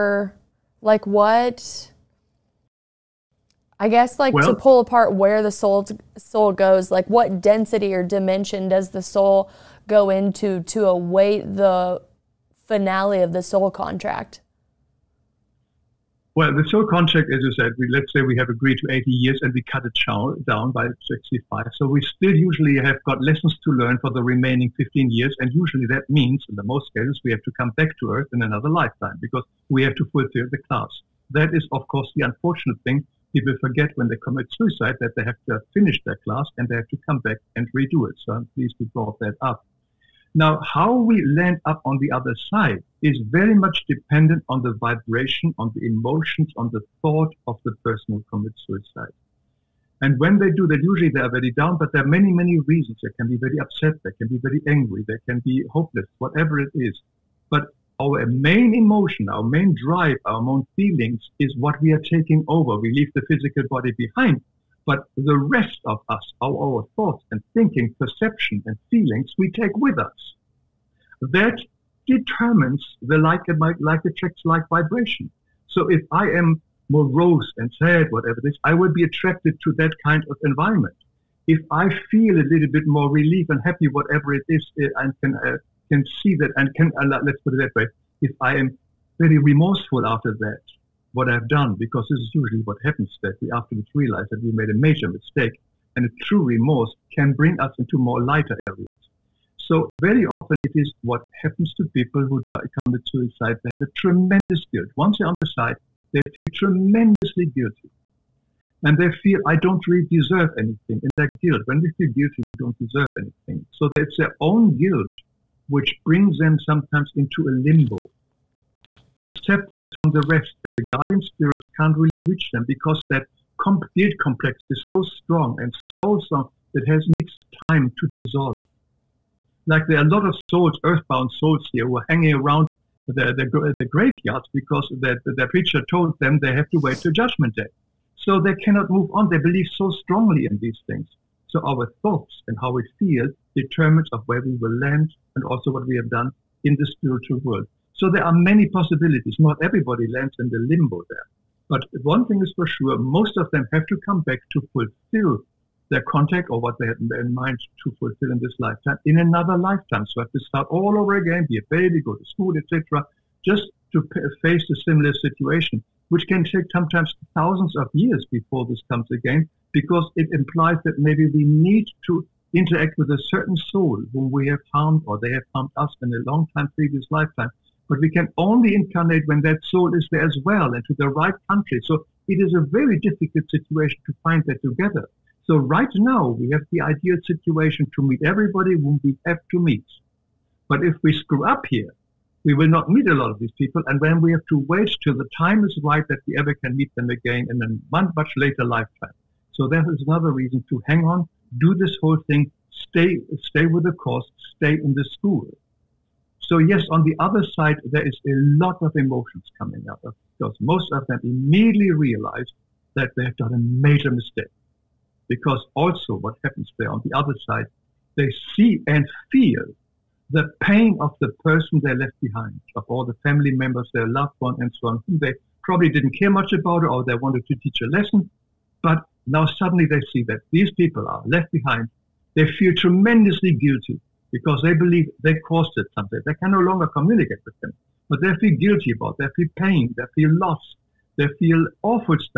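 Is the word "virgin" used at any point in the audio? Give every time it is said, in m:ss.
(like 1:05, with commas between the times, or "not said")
not said.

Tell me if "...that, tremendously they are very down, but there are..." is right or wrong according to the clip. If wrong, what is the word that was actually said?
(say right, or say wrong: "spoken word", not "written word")
wrong: "usually", not "tremendously".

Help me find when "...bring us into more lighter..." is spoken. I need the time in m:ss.
1:37.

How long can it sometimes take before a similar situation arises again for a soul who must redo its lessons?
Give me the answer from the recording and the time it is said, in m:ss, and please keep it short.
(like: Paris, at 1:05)
thousands of years, at 2:47.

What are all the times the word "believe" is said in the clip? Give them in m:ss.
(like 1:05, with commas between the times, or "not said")
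2:19, 3:54.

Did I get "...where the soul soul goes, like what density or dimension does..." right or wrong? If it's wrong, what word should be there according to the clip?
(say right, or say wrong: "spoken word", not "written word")
right.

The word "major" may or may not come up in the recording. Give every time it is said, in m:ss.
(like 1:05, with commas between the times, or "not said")
1:34, 3:33.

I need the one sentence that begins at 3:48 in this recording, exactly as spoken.
But now suddenly they see that these people are left behind.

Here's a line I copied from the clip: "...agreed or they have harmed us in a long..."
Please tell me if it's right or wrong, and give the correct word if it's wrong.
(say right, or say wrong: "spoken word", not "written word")
wrong: "harmed", not "agreed".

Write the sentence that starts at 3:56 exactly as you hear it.
They can no longer communicate with them, but they feel guilty about.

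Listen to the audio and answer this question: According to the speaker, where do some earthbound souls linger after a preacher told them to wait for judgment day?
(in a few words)
graveyards.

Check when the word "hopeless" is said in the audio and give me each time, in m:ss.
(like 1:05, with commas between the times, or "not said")
0:55.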